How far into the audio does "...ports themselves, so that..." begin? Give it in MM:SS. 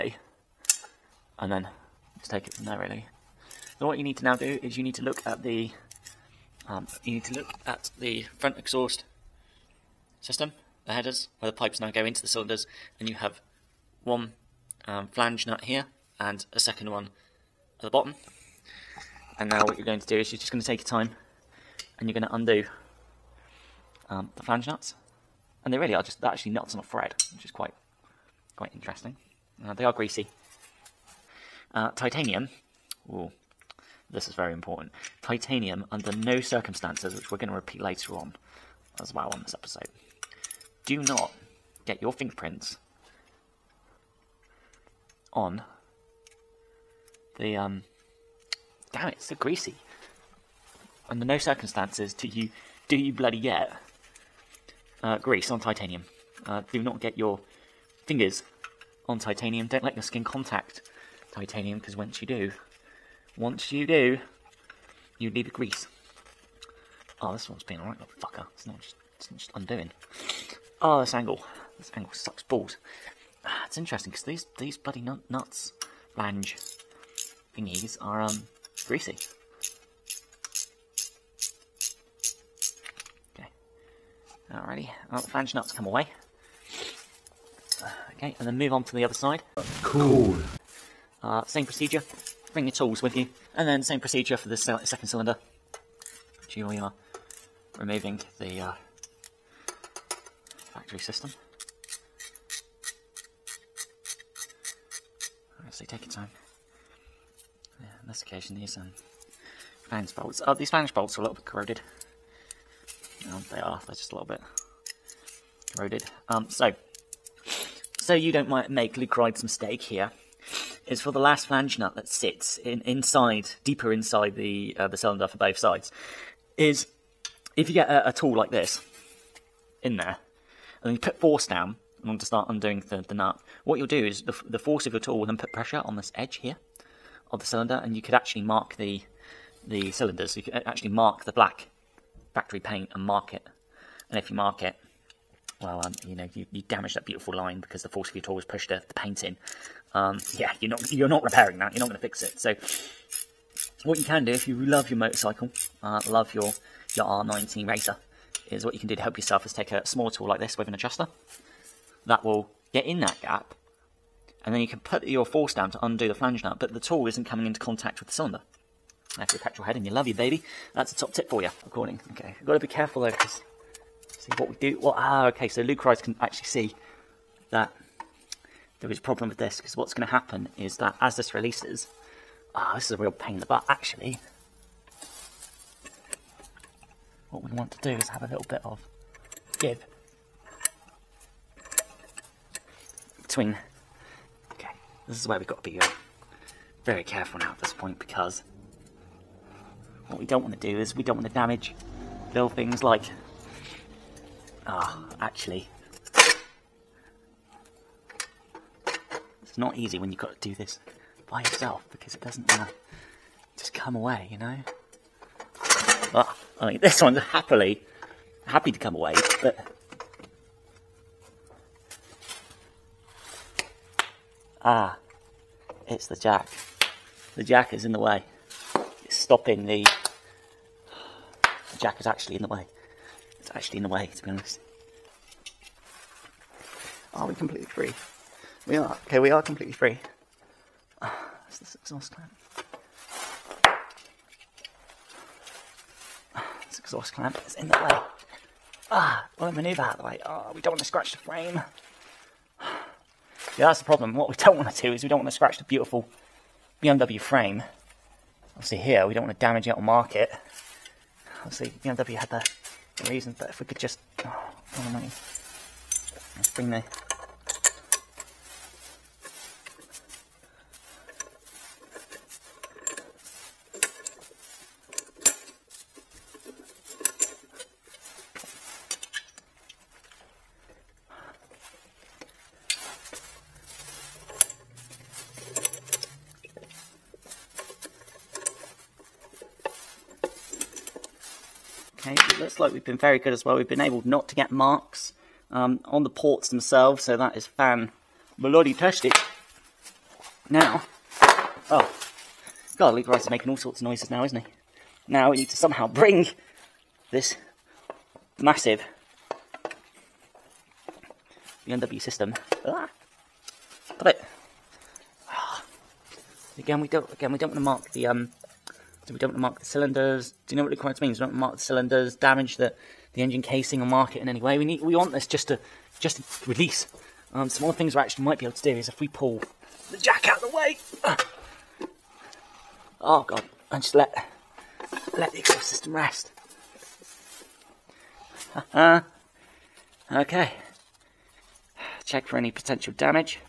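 04:56.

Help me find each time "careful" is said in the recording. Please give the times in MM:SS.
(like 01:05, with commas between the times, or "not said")
02:52, 03:17.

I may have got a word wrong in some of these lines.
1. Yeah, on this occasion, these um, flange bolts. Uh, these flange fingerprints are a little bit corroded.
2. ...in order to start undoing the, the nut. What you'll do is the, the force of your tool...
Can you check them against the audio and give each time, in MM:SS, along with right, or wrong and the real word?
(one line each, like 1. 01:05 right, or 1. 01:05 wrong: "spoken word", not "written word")
1. 01:47 wrong: "bolts", not "fingerprints"
2. 02:12 right.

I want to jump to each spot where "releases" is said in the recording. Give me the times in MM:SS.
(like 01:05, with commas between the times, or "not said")
03:01, 05:26.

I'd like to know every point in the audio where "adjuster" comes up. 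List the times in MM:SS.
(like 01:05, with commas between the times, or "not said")
02:40.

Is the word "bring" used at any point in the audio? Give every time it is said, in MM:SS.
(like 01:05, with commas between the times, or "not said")
01:32, 04:26, 05:05.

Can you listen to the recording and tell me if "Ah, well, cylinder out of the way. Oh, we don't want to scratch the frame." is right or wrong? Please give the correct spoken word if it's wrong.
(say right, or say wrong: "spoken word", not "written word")
wrong: "maneuver", not "cylinder".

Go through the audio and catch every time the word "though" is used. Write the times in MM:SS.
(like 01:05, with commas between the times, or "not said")
02:52.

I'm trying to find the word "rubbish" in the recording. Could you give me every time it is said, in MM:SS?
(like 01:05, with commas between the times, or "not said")
not said.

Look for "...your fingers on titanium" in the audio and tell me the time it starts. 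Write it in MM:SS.
00:57.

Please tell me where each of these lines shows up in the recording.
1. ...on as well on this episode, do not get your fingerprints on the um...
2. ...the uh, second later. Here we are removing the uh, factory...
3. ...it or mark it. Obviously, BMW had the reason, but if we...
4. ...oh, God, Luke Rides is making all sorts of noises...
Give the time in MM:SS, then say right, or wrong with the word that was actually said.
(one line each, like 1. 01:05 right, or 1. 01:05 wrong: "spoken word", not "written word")
1. 00:38 right
2. 01:34 wrong: "cylinder", not "later"
3. 04:19 right
4. 05:01 right.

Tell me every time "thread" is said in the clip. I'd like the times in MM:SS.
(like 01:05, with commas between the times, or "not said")
00:26.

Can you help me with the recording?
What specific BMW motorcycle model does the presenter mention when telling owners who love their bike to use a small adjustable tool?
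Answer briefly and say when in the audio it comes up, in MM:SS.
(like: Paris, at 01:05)
R NineT racer, at 02:37.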